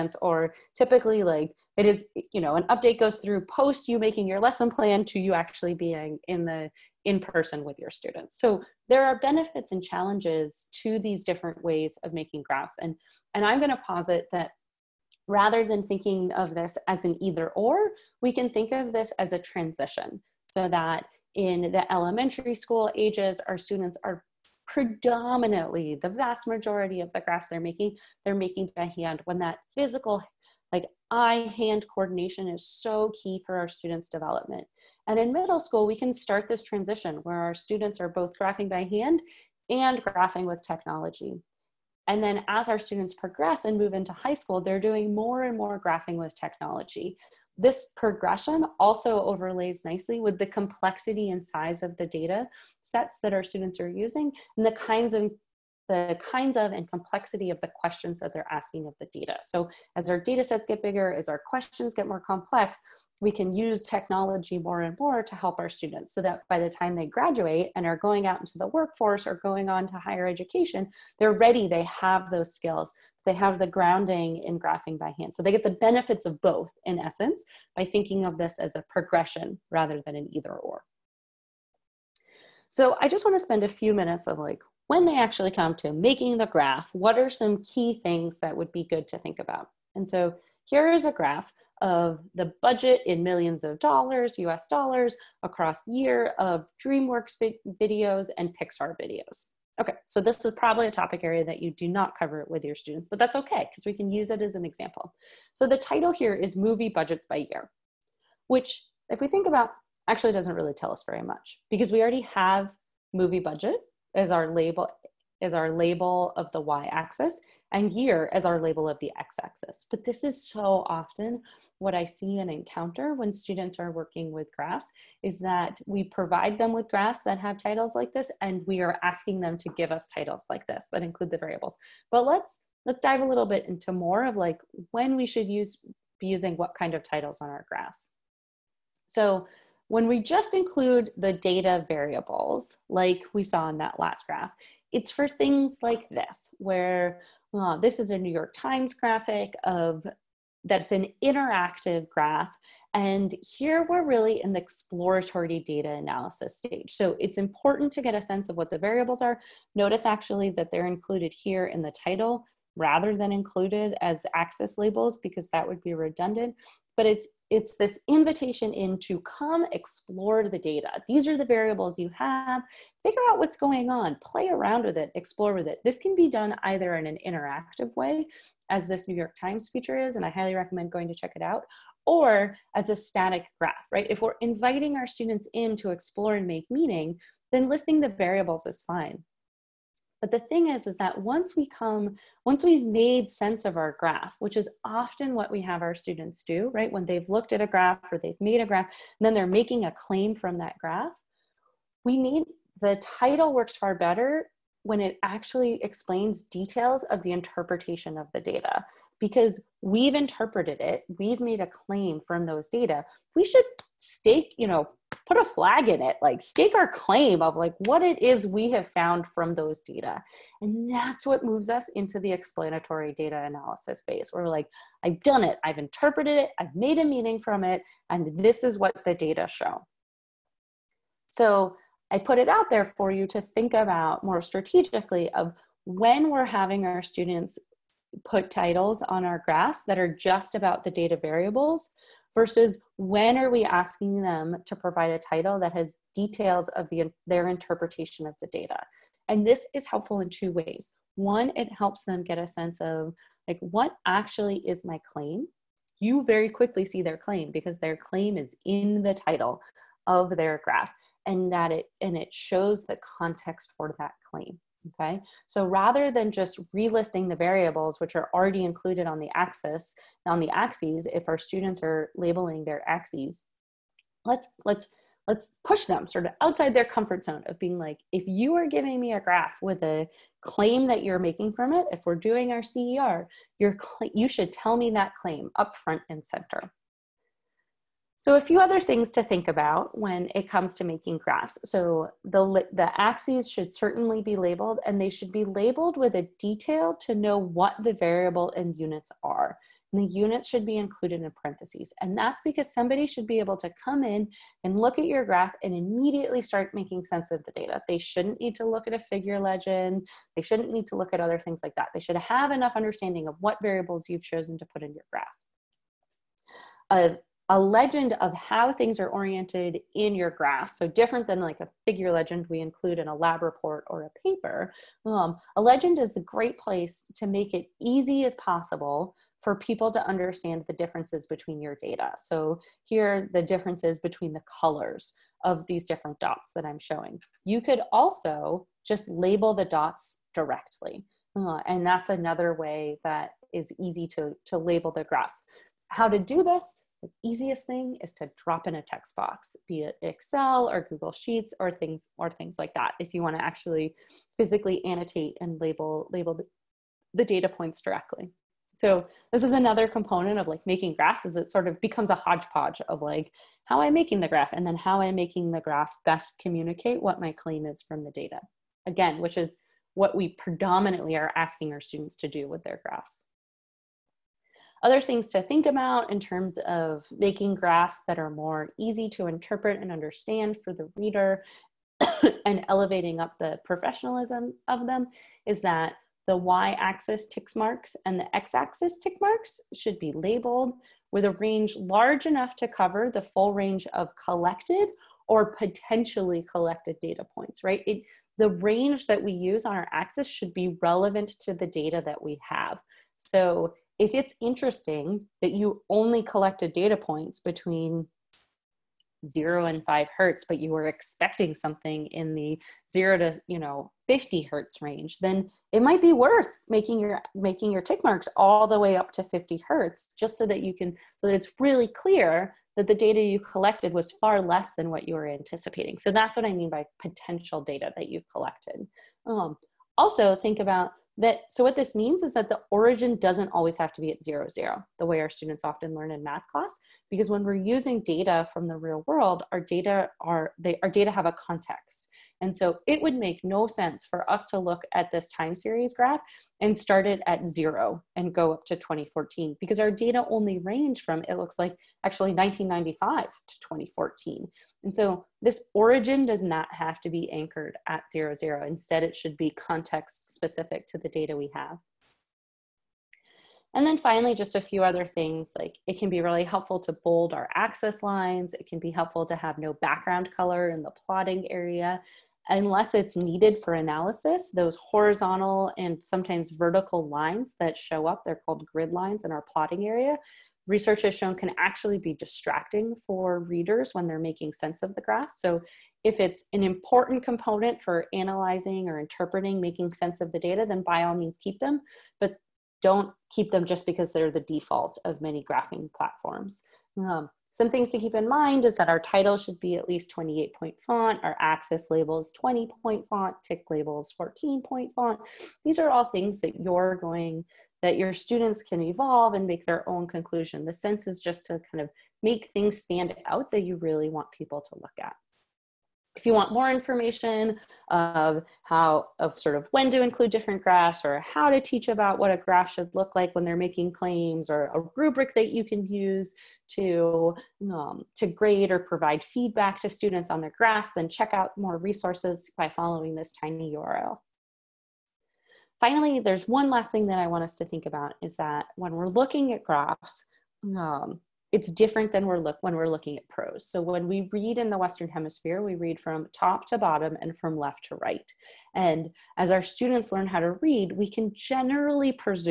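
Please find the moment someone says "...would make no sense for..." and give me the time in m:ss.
7:22.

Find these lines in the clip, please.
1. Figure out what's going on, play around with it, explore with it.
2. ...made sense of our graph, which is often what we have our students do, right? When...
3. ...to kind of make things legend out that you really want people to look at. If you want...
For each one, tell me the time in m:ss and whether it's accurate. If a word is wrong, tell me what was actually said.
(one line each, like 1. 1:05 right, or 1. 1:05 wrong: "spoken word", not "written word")
1. 2:53 right
2. 3:12 right
3. 8:31 wrong: "stand", not "legend".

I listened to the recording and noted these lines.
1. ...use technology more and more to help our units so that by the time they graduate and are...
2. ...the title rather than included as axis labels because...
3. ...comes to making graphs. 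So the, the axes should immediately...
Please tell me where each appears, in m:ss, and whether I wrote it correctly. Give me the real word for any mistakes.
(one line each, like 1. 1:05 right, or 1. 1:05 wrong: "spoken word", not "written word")
1. 1:03 wrong: "students", not "units"
2. 2:41 right
3. 4:50 wrong: "certainly", not "immediately".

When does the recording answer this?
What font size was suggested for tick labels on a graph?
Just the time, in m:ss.
8:24.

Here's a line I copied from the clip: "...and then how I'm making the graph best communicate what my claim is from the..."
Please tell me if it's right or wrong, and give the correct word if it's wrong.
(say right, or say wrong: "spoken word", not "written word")
right.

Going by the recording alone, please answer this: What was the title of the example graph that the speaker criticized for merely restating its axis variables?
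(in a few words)
Movie Budgets by Year.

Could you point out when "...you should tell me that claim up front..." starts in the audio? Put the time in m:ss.
4:44.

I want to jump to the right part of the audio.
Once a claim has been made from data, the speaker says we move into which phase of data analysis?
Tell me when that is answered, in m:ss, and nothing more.
3:42.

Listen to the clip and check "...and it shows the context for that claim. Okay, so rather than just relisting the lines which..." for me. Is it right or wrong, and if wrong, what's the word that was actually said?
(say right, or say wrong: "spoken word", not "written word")
wrong: "variables", not "lines".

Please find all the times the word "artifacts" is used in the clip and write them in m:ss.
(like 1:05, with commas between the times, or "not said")
not said.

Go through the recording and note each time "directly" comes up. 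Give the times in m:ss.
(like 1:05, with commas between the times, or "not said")
5:40, 5:57.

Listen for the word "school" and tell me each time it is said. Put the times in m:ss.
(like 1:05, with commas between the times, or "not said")
0:22, 0:35, 0:44.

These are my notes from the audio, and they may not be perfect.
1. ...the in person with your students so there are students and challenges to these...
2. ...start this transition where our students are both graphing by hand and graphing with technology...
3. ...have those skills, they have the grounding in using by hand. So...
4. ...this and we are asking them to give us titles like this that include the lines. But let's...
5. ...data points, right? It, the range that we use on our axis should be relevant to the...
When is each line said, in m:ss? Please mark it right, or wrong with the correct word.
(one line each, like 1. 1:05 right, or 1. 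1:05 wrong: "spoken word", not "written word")
1. 0:06 wrong: "benefits", not "students"
2. 0:36 right
3. 1:11 wrong: "graphing", not "using"
4. 2:08 wrong: "variables", not "lines"
5. 6:36 right.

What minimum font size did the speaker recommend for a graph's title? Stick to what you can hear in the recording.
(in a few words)
28 point.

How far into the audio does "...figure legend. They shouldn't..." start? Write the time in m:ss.
5:08.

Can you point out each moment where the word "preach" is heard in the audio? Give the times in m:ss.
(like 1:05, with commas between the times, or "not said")
not said.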